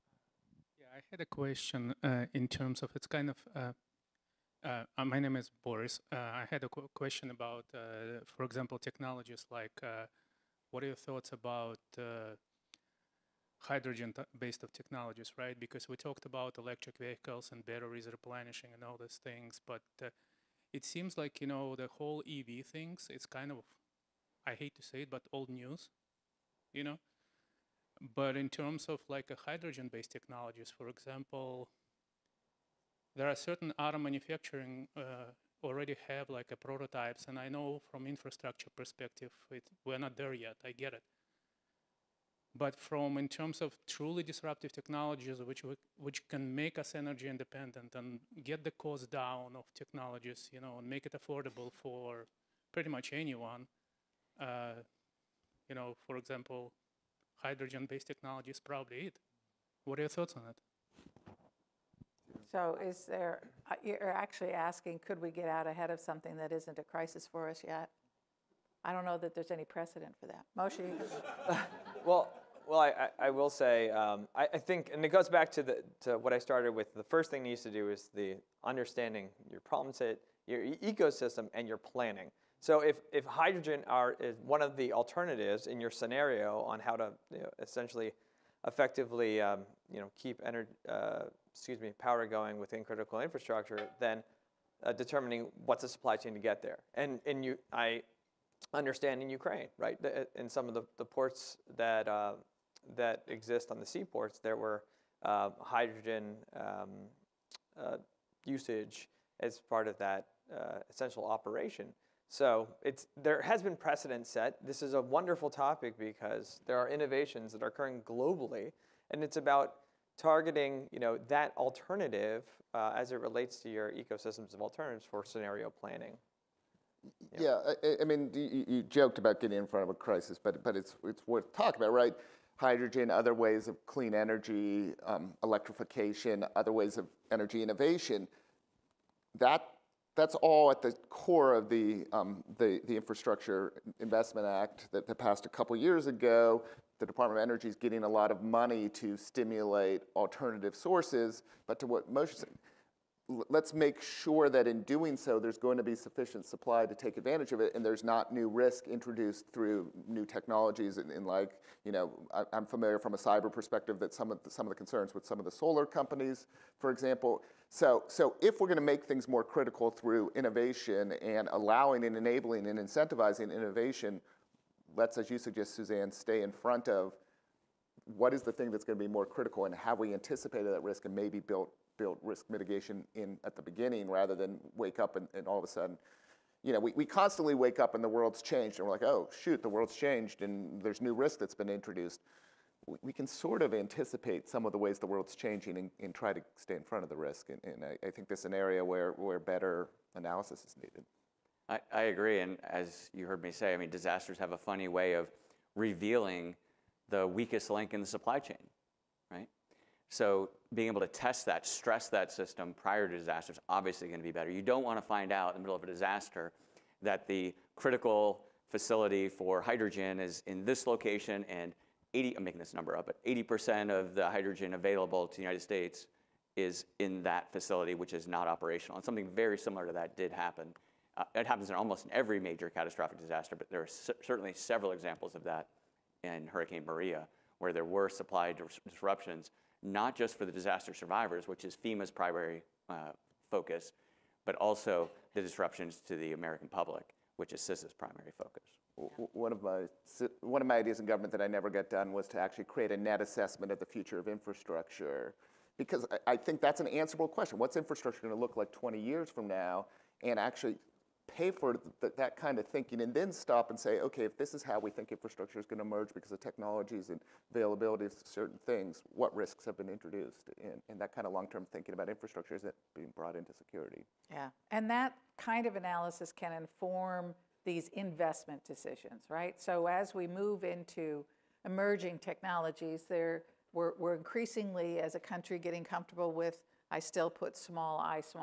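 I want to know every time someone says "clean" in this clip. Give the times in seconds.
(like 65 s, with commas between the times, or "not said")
133 s.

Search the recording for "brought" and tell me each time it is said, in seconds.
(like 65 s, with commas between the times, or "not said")
273 s.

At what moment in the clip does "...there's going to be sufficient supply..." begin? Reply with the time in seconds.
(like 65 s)
155 s.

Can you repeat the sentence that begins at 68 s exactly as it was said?
I don't know that there's any precedent for that.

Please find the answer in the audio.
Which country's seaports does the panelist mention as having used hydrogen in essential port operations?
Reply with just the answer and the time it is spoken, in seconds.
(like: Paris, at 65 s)
Ukraine, at 99 s.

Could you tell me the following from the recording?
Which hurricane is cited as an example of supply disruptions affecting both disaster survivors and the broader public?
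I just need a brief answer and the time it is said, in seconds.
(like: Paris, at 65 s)
Hurricane Maria, at 236 s.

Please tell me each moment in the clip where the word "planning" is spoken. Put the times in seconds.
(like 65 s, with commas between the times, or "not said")
81 s, 125 s.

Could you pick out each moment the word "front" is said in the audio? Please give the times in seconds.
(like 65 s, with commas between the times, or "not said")
129 s, 176 s, 196 s.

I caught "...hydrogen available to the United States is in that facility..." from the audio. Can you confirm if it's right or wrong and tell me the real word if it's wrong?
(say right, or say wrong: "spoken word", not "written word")
right.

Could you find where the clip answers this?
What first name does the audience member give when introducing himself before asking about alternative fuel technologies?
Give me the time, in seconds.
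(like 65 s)
5 s.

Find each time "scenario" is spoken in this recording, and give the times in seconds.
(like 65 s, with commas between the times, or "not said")
85 s, 125 s.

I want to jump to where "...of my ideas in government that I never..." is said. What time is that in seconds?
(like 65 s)
250 s.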